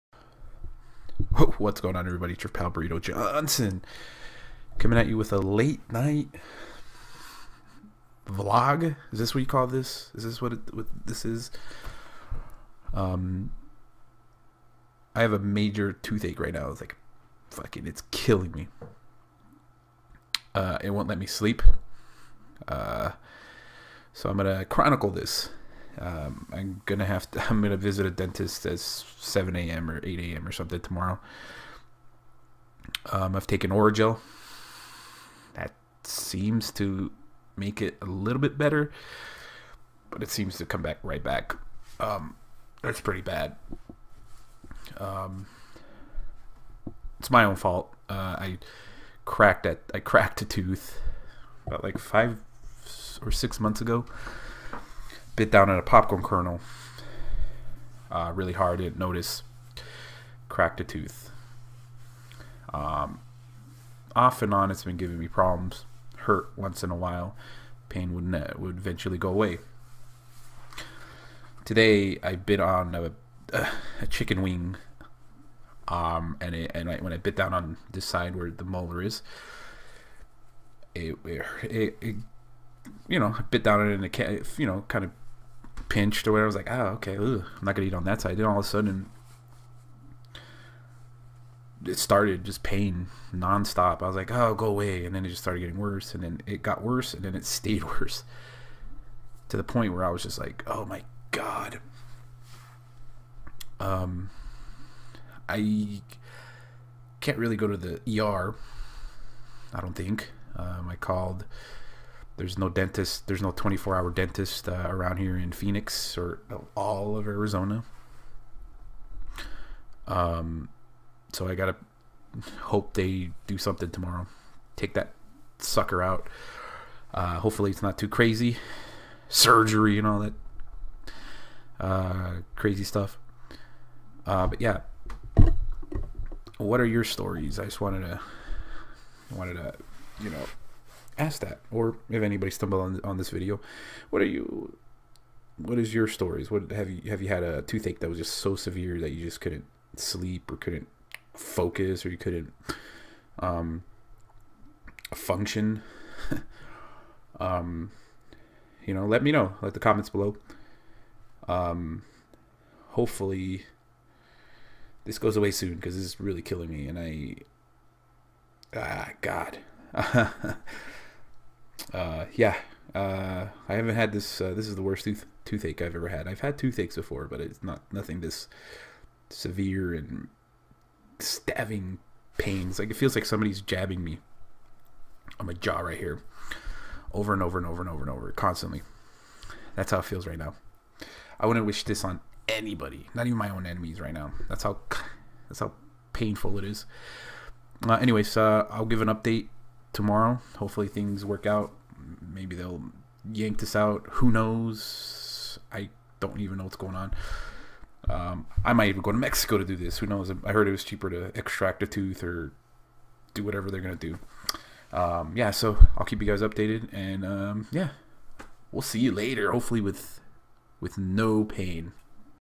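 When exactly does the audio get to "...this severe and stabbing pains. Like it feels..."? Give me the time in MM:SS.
02:58.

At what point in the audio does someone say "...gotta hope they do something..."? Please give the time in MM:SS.
02:01.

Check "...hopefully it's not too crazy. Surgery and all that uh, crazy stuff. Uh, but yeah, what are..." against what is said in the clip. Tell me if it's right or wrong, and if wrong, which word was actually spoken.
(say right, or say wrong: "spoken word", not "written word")
right.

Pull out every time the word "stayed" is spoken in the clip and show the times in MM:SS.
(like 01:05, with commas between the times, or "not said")
01:37.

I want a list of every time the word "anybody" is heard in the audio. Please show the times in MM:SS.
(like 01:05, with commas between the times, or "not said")
02:22, 03:12.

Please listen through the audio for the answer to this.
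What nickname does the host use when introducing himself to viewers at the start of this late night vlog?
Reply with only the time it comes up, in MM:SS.
00:02.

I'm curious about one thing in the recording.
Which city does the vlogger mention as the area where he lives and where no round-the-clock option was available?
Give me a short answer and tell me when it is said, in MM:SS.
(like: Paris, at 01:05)
Phoenix, at 01:55.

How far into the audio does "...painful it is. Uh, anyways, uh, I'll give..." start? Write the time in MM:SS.
03:16.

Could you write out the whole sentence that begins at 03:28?
Um, I might even go to Mexico to do this.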